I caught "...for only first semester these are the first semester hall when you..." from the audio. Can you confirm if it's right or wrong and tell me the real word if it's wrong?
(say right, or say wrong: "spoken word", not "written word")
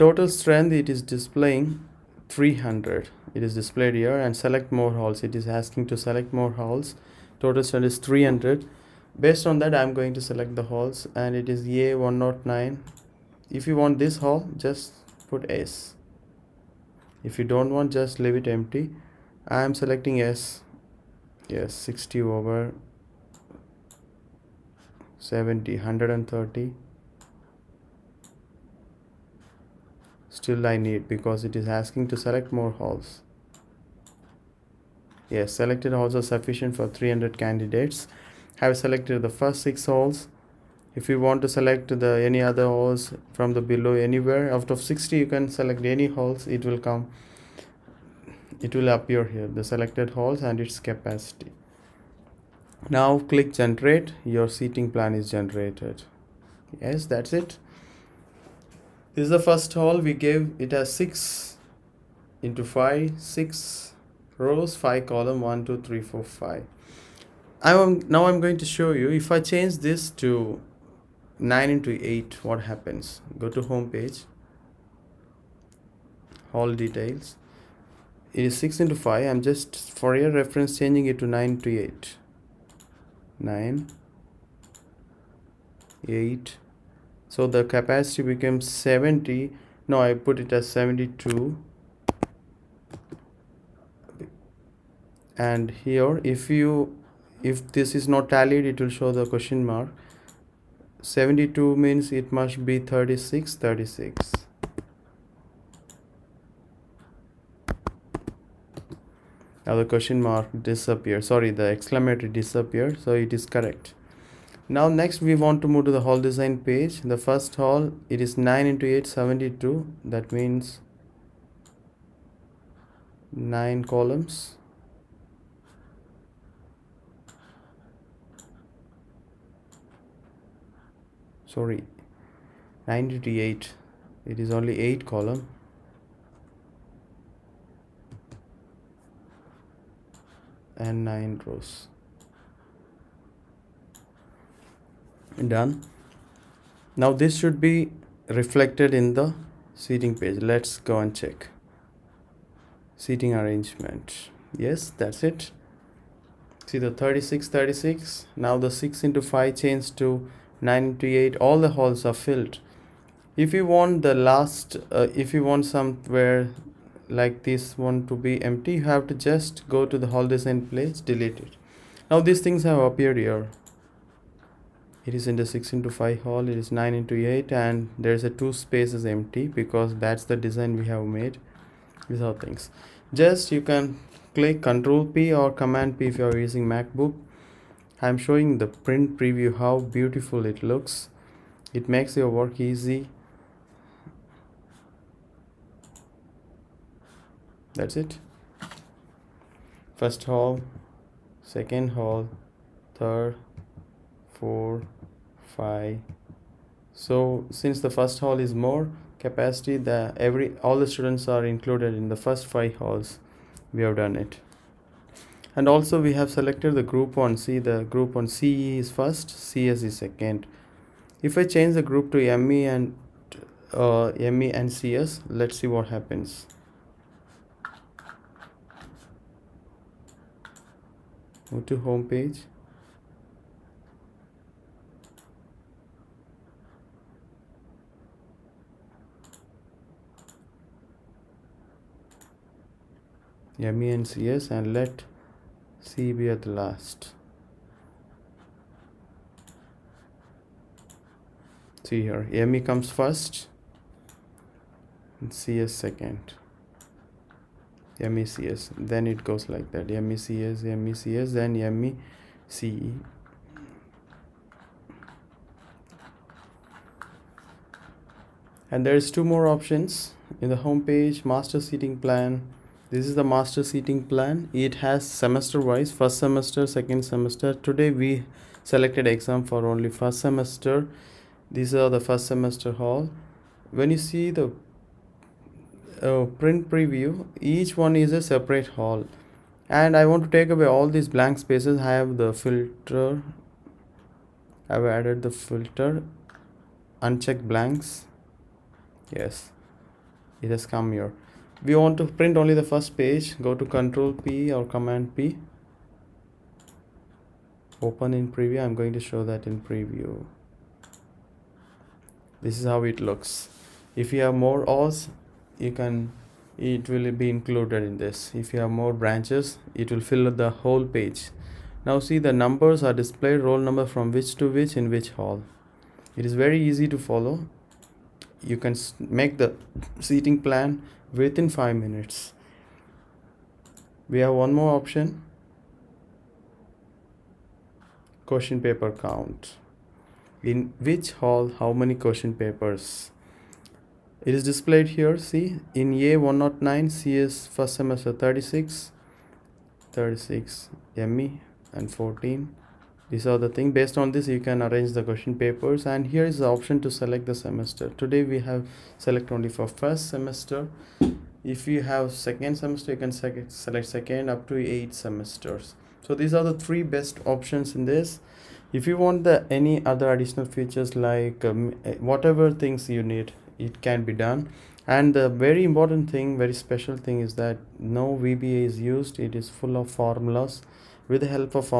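right.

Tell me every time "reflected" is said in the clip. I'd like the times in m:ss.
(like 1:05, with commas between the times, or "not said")
2:28.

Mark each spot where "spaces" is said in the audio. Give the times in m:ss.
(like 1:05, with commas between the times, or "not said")
2:58, 4:51.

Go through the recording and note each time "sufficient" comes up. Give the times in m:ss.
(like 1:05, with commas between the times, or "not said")
0:36.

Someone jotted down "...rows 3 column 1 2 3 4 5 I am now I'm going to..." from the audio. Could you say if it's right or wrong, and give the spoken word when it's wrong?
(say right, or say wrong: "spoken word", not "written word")
wrong: "5", not "3".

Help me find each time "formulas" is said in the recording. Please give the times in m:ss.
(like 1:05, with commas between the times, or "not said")
6:19.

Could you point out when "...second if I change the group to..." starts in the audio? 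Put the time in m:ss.
3:39.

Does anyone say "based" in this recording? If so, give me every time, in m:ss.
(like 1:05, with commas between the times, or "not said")
0:09, 5:53.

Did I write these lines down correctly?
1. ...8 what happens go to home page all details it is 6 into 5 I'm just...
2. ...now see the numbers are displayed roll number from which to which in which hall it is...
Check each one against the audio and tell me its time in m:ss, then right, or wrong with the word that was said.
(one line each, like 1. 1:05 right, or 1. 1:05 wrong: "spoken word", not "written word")
1. 1:12 right
2. 5:21 right.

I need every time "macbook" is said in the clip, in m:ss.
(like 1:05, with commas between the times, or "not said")
3:06.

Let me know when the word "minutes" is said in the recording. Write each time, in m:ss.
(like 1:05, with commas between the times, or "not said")
5:31.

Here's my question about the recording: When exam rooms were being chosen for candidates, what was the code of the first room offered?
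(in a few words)
A109.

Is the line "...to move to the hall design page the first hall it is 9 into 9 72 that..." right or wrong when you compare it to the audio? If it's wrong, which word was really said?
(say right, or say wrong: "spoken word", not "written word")
wrong: "8", not "9".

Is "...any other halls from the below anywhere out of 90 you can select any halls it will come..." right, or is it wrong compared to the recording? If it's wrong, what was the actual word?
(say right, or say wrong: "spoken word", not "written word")
wrong: "60", not "90".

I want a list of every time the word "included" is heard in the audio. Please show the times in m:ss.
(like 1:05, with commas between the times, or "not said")
3:31, 5:17.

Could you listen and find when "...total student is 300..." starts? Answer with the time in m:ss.
0:07.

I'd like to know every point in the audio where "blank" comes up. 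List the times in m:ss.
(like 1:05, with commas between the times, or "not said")
4:51, 4:57.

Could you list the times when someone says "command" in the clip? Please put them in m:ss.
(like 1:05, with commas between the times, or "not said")
3:05, 5:04.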